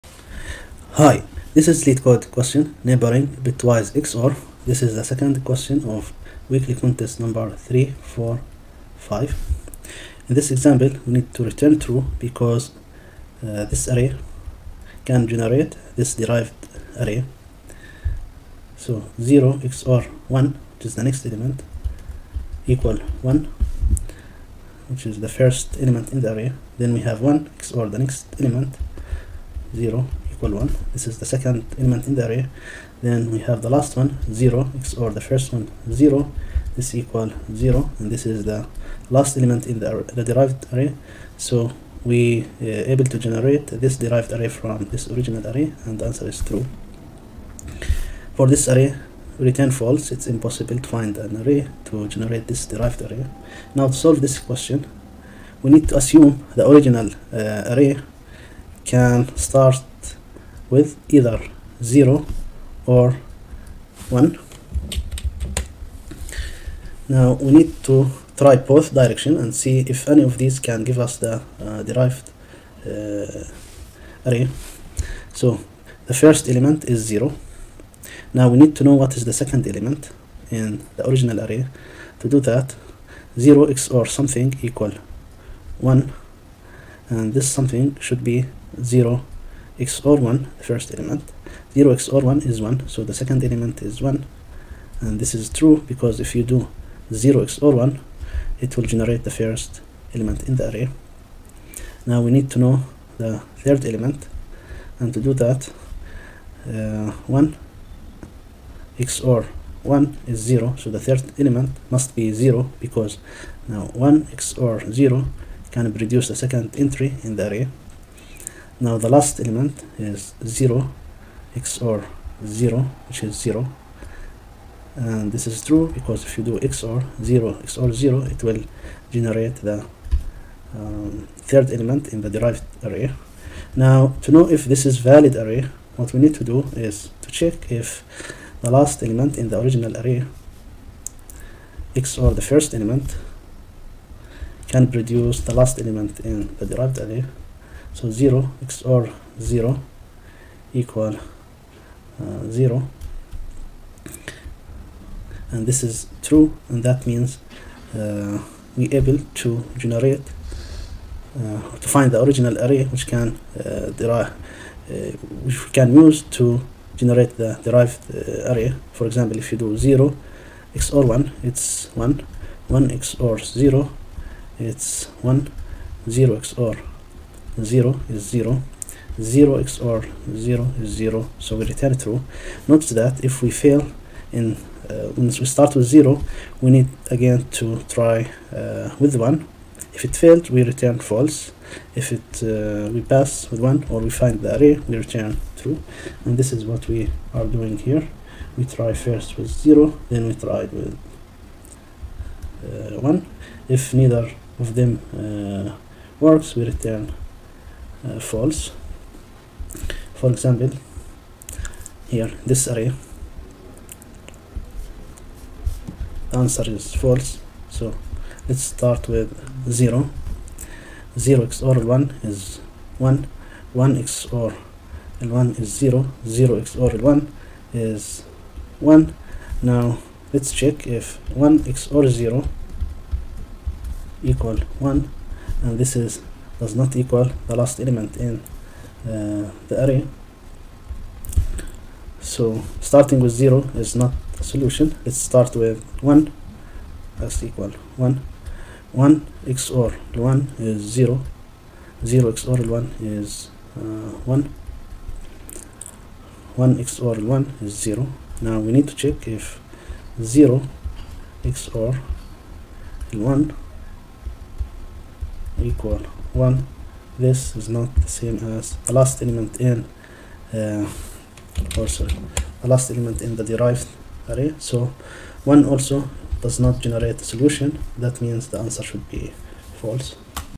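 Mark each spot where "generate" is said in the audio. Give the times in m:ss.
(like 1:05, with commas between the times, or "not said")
0:15, 0:43, 0:52, 1:38, 2:09, 2:39, 2:46, 4:36.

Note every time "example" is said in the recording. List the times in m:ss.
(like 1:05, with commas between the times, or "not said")
0:10, 2:49, 3:30.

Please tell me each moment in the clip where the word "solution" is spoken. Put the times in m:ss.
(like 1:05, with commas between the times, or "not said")
4:04, 4:37.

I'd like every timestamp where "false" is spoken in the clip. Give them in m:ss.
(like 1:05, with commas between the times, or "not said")
0:49, 3:10, 3:28, 3:36, 4:39.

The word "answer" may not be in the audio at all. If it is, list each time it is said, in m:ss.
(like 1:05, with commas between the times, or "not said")
0:46, 3:36, 4:38.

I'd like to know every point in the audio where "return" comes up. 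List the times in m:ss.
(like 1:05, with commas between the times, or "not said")
0:11, 0:49, 3:01, 3:10, 3:14, 3:26.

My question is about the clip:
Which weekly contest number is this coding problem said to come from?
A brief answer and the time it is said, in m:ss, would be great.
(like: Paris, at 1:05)
345, at 0:07.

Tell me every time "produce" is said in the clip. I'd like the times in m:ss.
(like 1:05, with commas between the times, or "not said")
1:55, 2:24.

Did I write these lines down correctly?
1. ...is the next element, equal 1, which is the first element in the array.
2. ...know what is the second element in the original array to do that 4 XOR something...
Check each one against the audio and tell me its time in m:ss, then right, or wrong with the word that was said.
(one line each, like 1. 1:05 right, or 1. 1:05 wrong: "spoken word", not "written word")
1. 0:20 right
2. 1:18 wrong: "0", not "4".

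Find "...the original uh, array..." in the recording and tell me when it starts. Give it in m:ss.
0:56.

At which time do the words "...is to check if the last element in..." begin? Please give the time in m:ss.
2:16.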